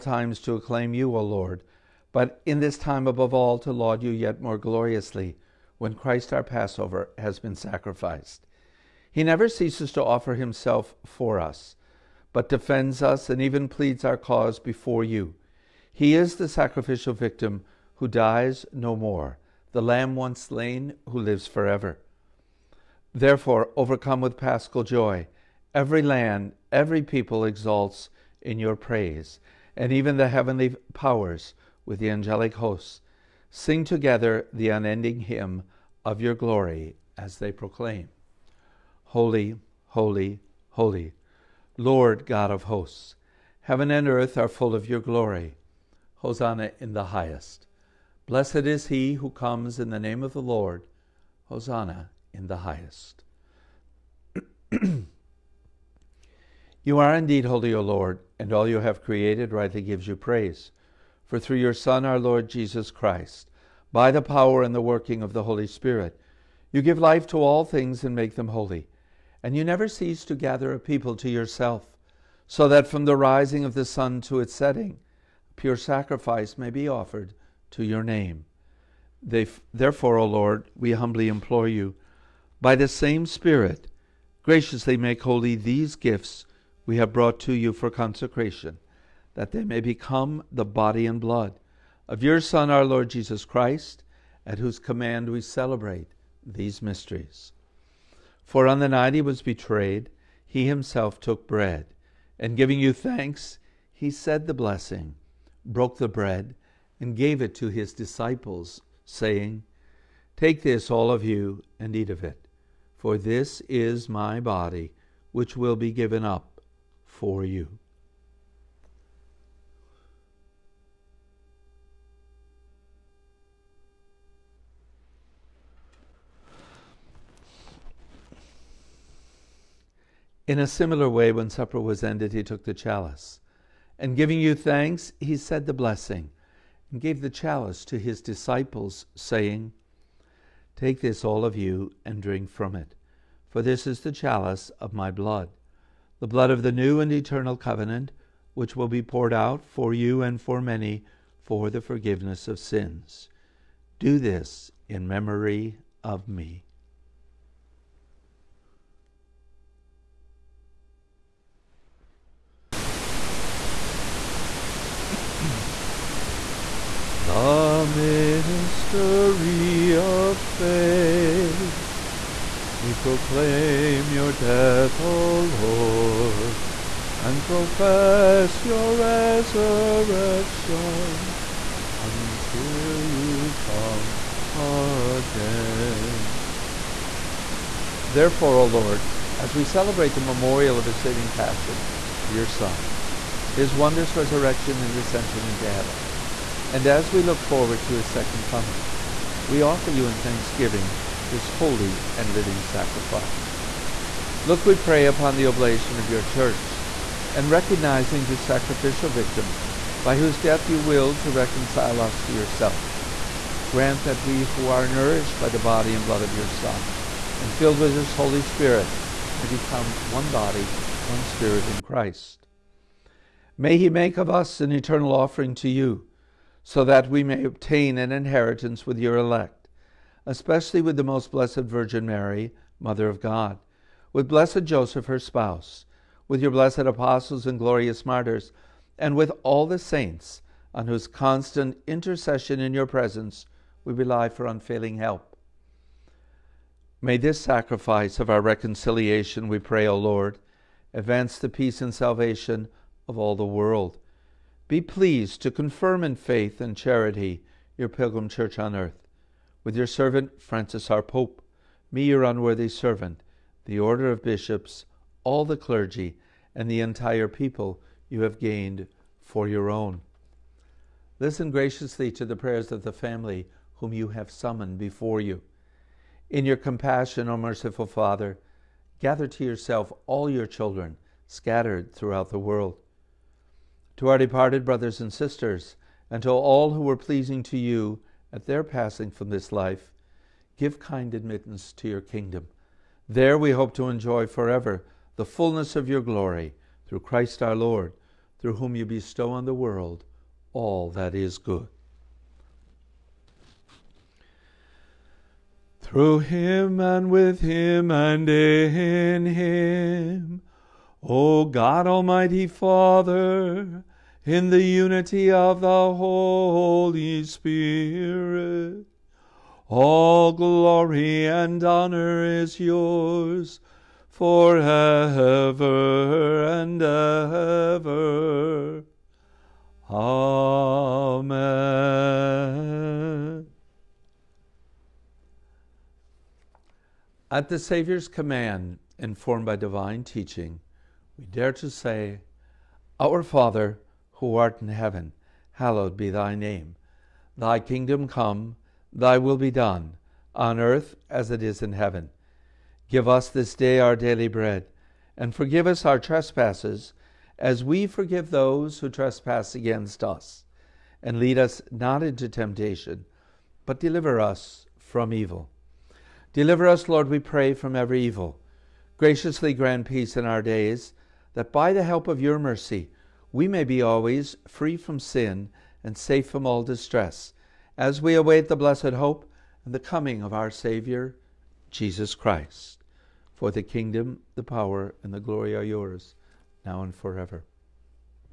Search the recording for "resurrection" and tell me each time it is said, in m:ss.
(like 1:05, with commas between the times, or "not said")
2:58, 3:14.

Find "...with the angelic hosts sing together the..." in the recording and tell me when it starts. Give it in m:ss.
0:31.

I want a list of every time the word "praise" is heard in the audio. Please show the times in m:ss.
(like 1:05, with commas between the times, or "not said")
0:28, 1:00.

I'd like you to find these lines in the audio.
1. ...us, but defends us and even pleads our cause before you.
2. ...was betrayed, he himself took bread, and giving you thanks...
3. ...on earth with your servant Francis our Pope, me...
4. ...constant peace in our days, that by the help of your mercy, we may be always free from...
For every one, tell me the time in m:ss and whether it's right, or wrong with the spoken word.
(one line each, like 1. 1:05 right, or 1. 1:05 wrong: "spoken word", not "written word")
1. 0:11 right
2. 1:39 right
3. 4:18 right
4. 6:09 wrong: "grant", not "constant".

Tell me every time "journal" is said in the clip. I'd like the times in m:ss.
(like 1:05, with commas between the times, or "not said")
not said.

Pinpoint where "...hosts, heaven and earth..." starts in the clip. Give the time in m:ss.
0:42.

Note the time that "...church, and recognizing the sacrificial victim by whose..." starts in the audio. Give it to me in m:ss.
3:26.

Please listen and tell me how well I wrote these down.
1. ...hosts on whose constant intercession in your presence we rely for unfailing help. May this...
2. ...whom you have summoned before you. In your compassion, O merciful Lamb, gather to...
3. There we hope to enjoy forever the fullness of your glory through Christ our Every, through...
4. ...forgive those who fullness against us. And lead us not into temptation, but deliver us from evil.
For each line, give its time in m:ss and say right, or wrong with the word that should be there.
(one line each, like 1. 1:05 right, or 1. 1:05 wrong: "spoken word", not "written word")
1. 3:59 wrong: "saints", not "hosts"
2. 4:33 wrong: "Father", not "Lamb"
3. 4:53 wrong: "Lord", not "Every"
4. 5:57 wrong: "trespass", not "fullness".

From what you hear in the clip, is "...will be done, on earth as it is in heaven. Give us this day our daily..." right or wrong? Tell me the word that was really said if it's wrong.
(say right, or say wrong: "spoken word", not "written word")
right.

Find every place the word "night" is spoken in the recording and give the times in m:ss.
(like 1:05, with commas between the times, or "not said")
1:38.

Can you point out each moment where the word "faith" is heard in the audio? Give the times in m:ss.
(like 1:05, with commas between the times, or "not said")
2:50, 4:16.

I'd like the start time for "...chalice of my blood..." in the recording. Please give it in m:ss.
2:24.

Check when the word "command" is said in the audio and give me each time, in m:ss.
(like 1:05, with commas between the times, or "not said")
1:34, 5:38.